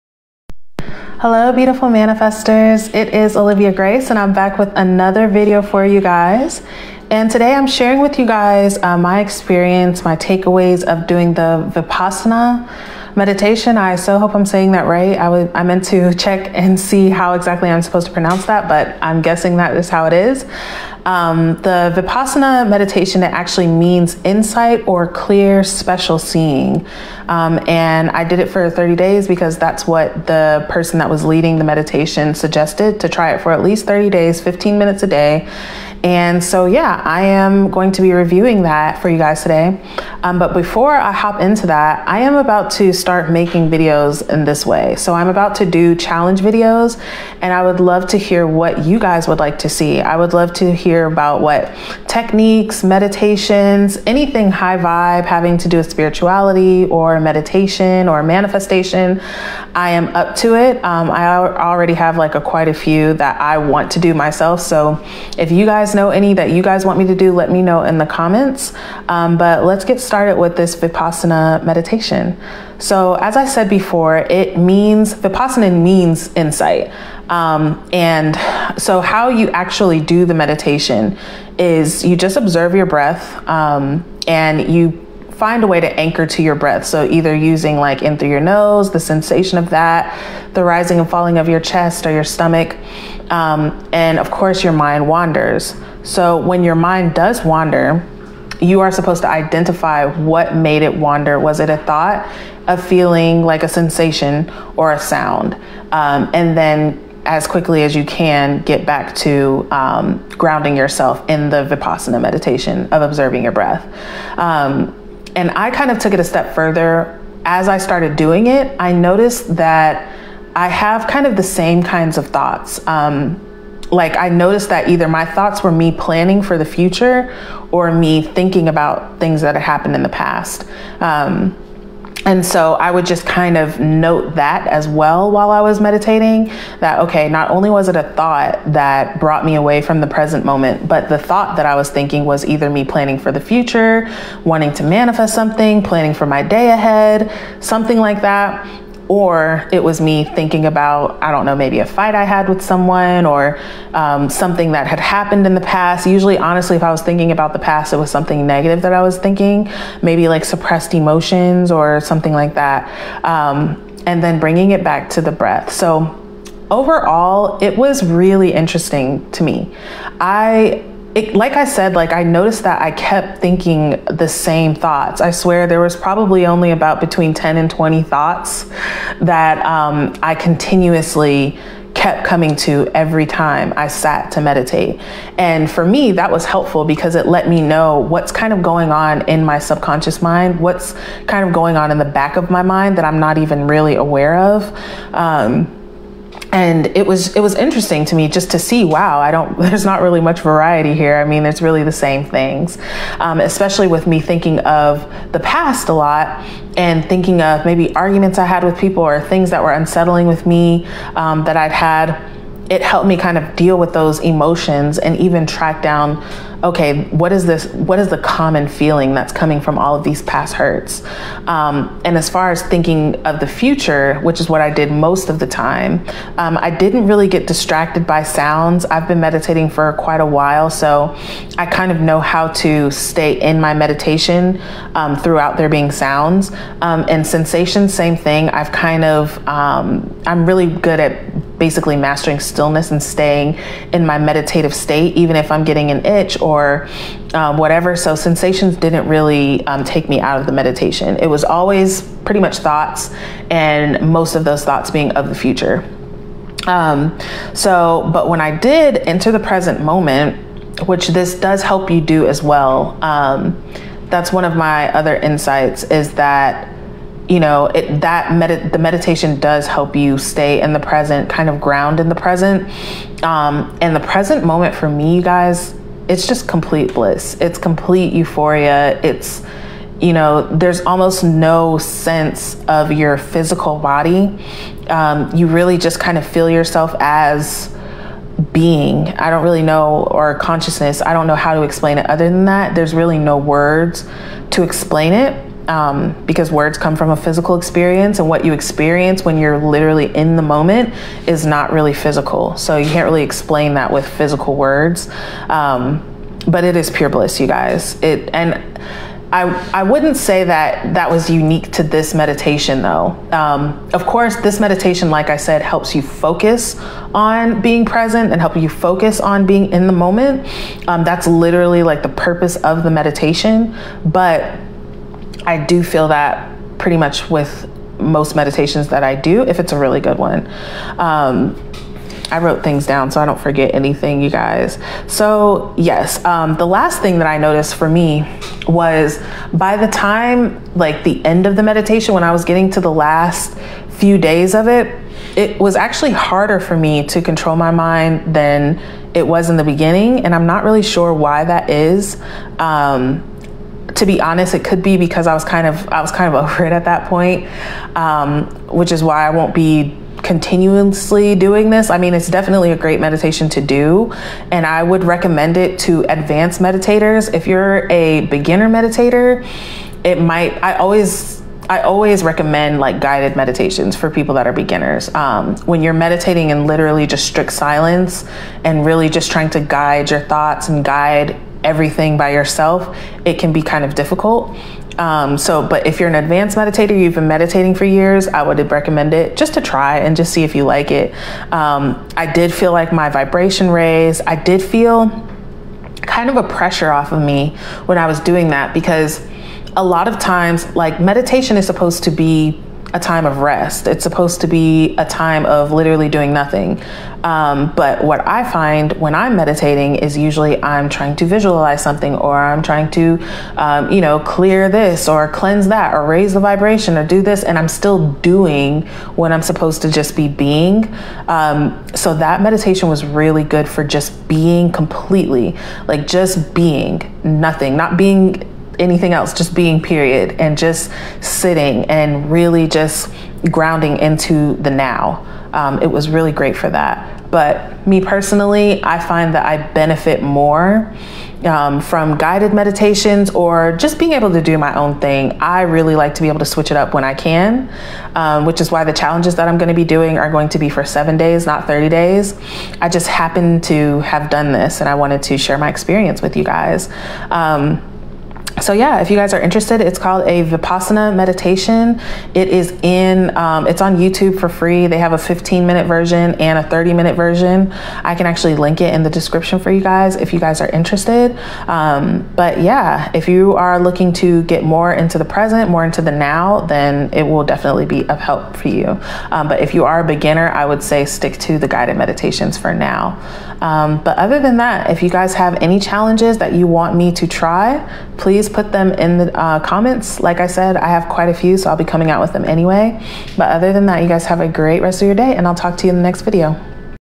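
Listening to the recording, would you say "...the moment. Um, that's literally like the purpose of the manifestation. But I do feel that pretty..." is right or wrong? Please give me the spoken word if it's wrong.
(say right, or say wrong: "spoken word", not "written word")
wrong: "meditation", not "manifestation".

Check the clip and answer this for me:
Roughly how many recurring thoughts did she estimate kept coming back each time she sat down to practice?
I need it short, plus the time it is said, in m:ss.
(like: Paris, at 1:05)
between 10 and 20, at 2:57.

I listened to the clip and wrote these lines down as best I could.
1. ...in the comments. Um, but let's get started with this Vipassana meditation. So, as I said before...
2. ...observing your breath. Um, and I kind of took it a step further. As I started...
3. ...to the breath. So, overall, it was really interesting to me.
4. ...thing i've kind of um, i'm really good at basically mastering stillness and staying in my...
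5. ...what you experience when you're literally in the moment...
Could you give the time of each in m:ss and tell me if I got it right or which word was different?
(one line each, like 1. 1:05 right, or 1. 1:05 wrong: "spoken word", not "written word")
1. 1:07 right
2. 1:53 right
3. 2:45 right
4. 3:58 right
5. 4:58 right.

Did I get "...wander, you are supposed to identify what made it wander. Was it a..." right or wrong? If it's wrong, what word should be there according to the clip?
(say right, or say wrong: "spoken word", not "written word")
right.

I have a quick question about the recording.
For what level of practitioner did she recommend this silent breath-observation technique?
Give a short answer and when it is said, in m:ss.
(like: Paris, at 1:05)
advanced meditators, at 6:06.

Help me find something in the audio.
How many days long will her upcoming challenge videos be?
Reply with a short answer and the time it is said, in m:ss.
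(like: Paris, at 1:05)
7 days, at 7:30.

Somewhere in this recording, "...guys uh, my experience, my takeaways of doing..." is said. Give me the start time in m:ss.
0:08.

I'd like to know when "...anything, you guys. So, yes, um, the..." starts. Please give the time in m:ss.
5:33.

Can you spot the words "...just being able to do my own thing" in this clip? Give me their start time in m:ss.
7:23.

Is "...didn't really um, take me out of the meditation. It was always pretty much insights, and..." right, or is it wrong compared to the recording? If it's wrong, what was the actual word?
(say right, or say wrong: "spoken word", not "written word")
wrong: "thoughts", not "insights".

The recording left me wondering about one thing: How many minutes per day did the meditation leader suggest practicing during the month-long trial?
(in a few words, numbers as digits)
15 minutes.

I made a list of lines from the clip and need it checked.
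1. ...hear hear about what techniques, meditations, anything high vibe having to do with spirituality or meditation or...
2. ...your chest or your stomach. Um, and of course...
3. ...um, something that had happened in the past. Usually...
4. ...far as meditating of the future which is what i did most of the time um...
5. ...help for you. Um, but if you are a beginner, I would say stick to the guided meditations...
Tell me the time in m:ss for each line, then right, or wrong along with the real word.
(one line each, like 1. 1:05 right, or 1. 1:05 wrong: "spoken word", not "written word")
1. 0:50 right
2. 1:31 right
3. 2:33 right
4. 3:42 wrong: "thinking", not "meditating"
5. 7:58 right.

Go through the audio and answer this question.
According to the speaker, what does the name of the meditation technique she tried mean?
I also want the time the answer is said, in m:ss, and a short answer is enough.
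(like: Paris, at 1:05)
insight or clear special seeing, at 0:24.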